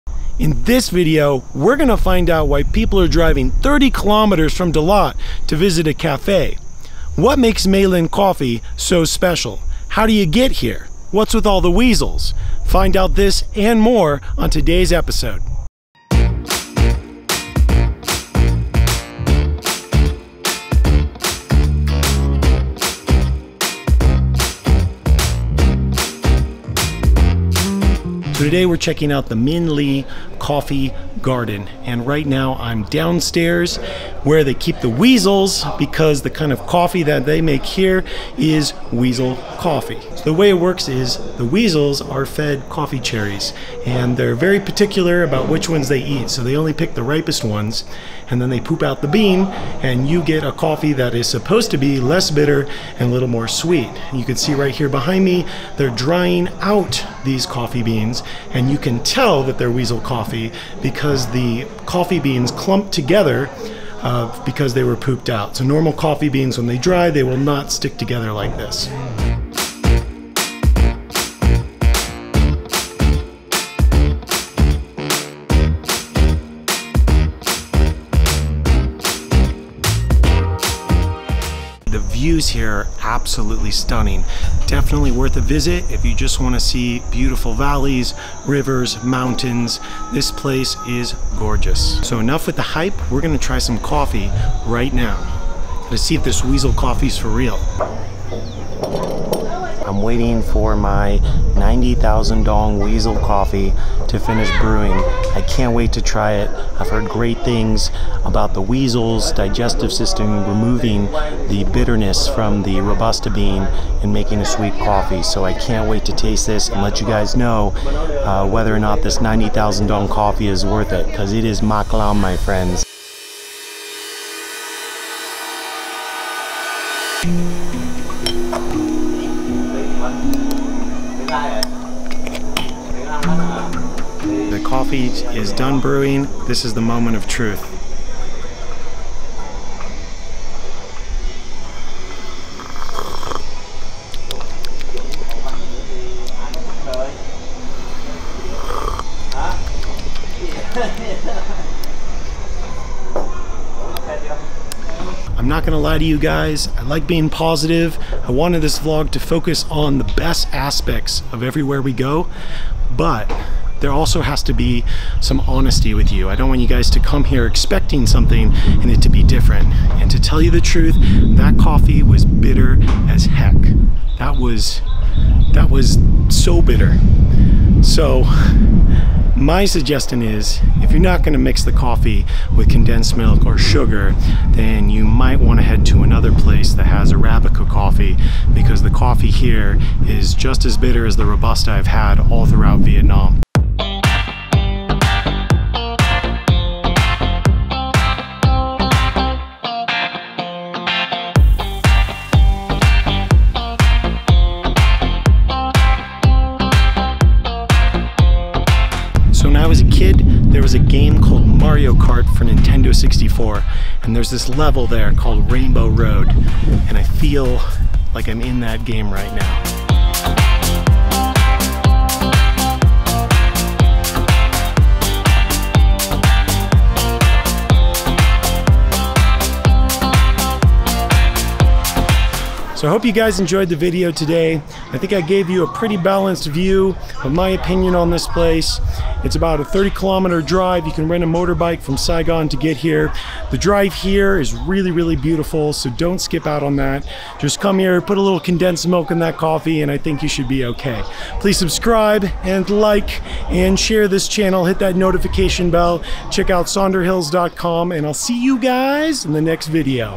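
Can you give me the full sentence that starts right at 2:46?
I don't want you guys to come here expecting something and it to be different.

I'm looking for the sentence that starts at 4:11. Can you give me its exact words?
Please subscribe and like and share this channel.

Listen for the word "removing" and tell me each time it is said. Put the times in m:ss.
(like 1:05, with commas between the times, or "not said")
1:50.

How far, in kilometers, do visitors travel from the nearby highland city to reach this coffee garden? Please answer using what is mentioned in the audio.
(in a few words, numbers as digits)
30 kilometers.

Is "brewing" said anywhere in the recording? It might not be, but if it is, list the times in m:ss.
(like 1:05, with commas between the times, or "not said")
1:44, 2:15.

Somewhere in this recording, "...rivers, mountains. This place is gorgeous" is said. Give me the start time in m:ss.
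1:28.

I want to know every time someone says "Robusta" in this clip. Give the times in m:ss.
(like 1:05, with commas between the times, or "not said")
1:52, 3:11.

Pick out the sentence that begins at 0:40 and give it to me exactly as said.
So the way it works is the weasels are fed coffee cherries and they're very particular about which ones they eat.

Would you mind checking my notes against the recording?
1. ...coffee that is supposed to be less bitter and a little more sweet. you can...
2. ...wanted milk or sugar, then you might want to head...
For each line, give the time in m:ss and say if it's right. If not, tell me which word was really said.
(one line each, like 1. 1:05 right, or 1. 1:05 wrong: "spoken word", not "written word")
1. 0:50 right
2. 3:02 wrong: "condensed", not "wanted".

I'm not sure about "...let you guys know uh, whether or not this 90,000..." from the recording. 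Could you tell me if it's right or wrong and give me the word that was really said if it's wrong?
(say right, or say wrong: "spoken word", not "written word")
right.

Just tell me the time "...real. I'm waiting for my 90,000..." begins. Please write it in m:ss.
1:37.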